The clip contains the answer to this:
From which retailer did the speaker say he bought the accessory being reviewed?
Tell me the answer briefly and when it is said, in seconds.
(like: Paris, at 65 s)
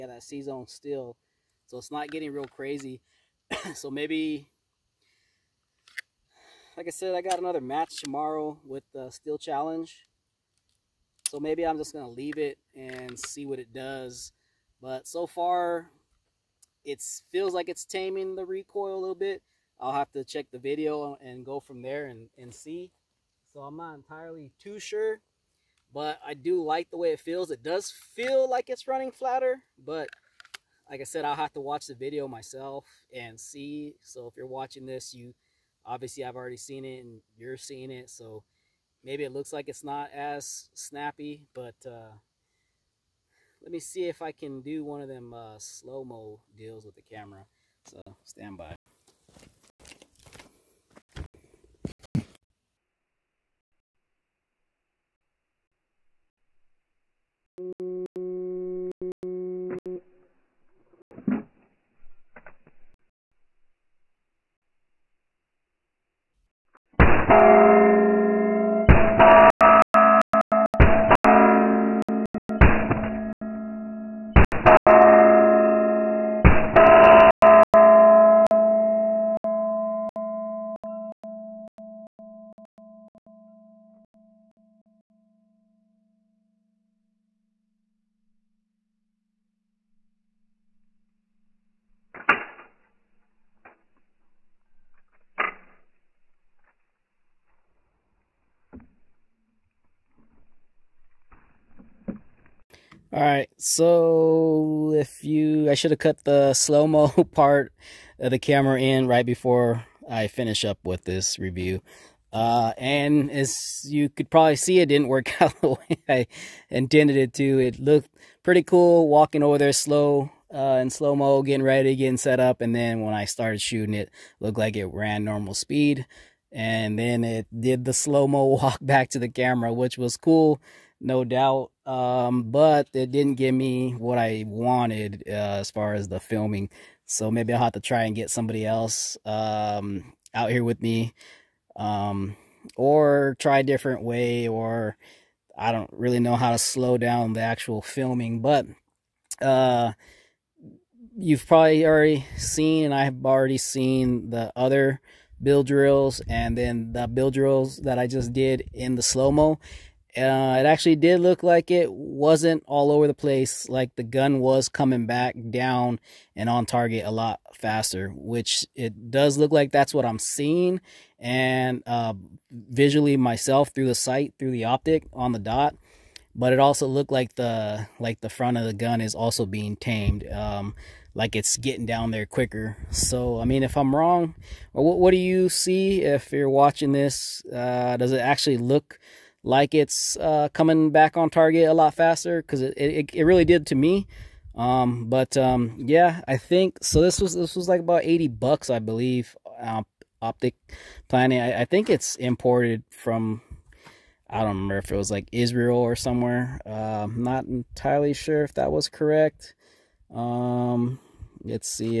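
Optics Planet, at 200 s.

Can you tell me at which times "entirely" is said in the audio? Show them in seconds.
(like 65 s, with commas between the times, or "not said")
23 s, 207 s.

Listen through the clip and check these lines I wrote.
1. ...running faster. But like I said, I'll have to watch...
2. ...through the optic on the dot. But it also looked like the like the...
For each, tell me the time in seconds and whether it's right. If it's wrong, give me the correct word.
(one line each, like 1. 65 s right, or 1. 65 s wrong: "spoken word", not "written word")
1. 28 s wrong: "flatter", not "faster"
2. 174 s right.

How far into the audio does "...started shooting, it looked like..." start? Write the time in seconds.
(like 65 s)
123 s.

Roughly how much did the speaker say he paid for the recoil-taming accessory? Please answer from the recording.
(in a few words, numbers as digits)
$80.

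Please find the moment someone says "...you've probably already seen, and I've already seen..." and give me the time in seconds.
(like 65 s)
151 s.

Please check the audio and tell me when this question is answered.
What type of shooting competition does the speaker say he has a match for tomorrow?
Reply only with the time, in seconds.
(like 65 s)
9 s.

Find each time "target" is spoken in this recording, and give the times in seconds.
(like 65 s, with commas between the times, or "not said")
166 s, 191 s.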